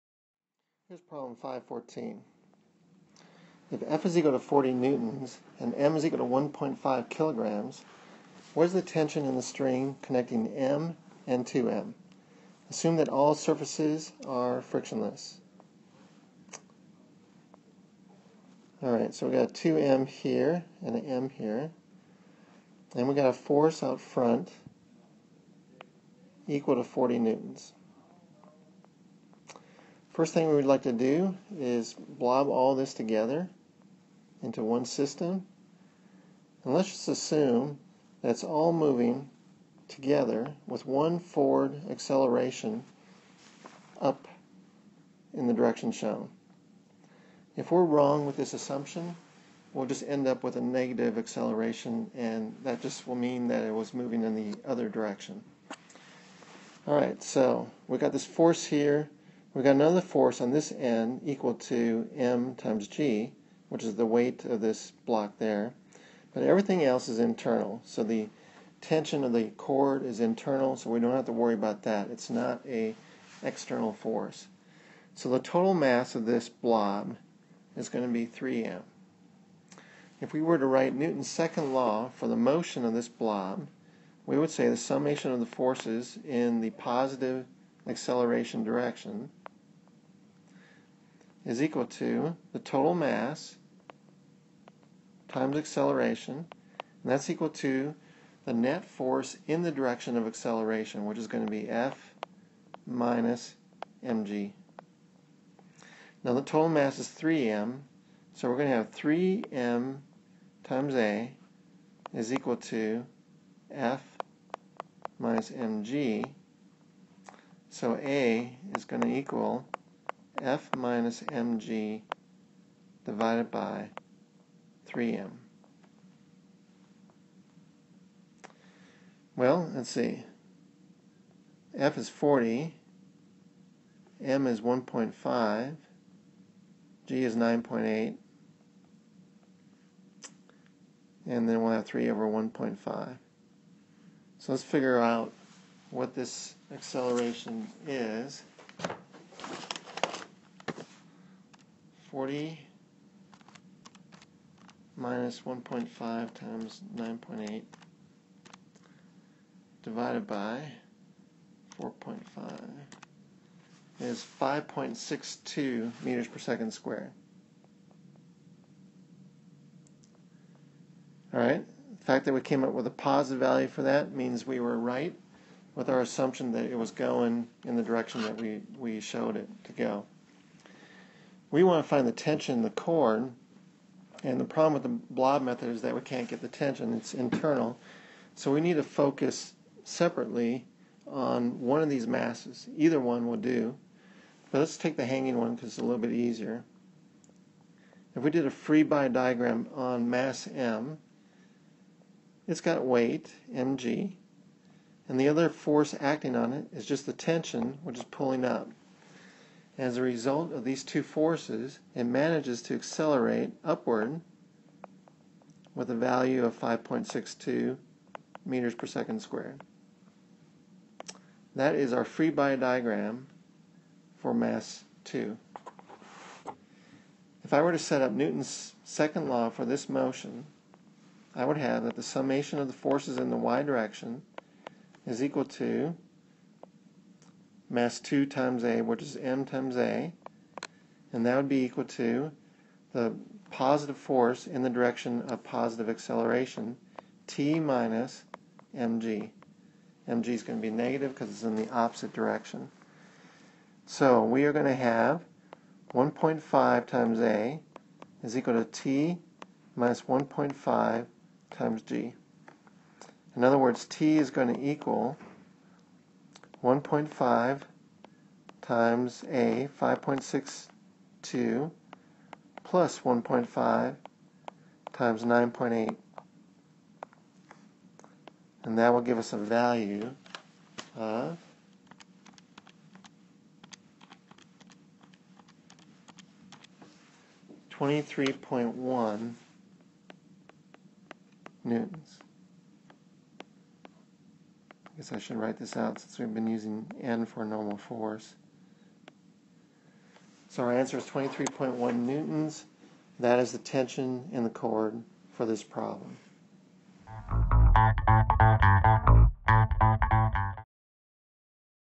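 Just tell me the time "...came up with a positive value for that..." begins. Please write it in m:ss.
2:52.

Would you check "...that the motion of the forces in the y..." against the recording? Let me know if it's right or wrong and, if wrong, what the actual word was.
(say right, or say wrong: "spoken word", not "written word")
wrong: "summation", not "motion".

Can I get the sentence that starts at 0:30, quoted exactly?
First thing we would like to do is blob all this together into one system.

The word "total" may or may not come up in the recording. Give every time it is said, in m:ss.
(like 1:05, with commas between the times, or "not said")
1:15, 1:32, 1:46.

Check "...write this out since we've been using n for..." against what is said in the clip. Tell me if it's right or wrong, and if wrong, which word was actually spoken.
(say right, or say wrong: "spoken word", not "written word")
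right.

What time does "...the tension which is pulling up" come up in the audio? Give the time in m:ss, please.
3:27.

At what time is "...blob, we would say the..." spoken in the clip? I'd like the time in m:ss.
1:23.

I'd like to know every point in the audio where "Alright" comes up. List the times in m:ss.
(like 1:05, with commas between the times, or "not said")
0:18, 0:56.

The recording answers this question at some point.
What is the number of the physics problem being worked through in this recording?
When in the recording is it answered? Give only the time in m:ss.
0:01.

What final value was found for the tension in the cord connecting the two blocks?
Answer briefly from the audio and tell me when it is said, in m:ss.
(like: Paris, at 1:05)
23.1 newtons, at 5:01.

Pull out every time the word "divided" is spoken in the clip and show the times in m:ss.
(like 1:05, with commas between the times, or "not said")
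2:03, 2:39.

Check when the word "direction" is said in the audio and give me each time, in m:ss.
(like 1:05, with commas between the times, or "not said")
0:45, 0:54, 1:28, 1:39, 2:57, 3:53, 4:04, 4:12.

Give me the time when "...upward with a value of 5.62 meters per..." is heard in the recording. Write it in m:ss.
3:33.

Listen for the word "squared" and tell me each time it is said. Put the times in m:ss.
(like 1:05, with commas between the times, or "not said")
2:46, 3:39.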